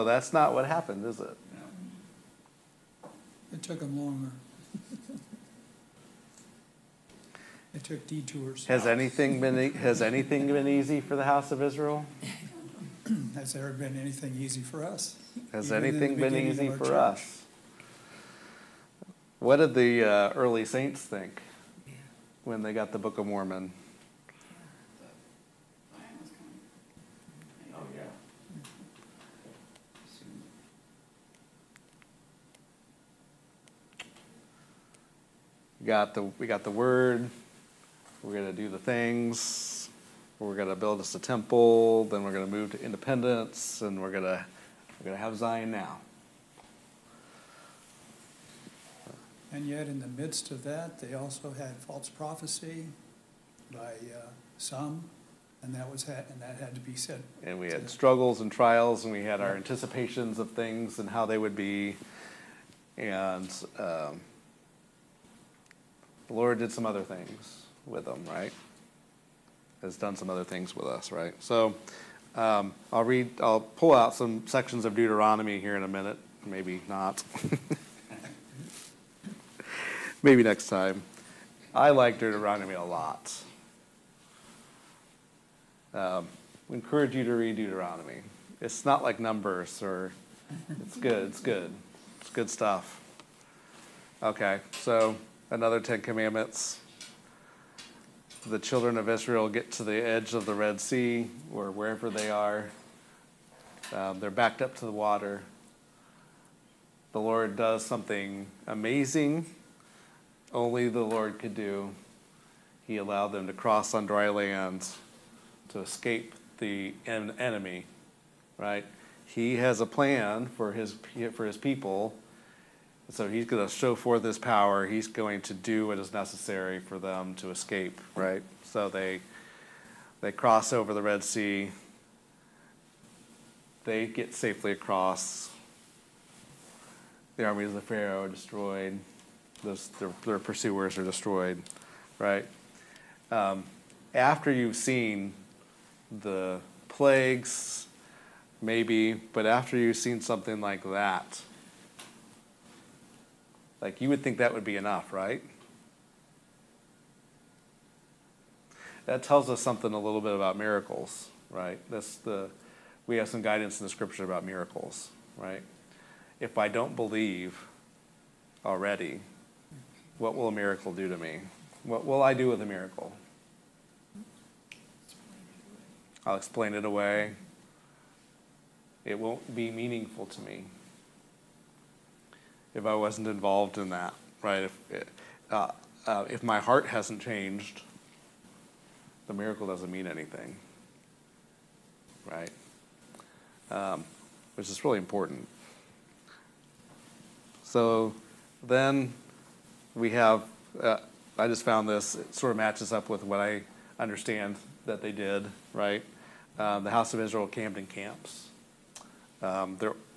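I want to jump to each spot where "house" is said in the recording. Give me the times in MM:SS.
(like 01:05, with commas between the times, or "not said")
00:11, 03:26.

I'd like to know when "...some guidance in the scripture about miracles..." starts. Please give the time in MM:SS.
02:43.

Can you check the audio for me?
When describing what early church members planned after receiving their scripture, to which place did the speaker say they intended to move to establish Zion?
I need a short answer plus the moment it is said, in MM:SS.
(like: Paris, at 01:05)
Independence, at 00:42.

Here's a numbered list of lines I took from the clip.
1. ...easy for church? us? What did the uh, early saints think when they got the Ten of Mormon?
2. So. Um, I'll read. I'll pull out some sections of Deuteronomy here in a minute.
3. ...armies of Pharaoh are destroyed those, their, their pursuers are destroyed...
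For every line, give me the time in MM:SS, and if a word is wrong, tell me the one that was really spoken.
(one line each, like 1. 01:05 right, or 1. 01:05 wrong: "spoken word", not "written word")
1. 00:16 wrong: "Book", not "Ten"
2. 01:11 right
3. 02:17 right.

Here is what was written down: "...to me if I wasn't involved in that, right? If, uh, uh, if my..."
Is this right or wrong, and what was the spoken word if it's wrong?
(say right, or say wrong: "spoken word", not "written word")
right.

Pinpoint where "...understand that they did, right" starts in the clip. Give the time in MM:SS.
03:23.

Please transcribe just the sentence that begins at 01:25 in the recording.
Um, we encourage you to read Deuteronomy.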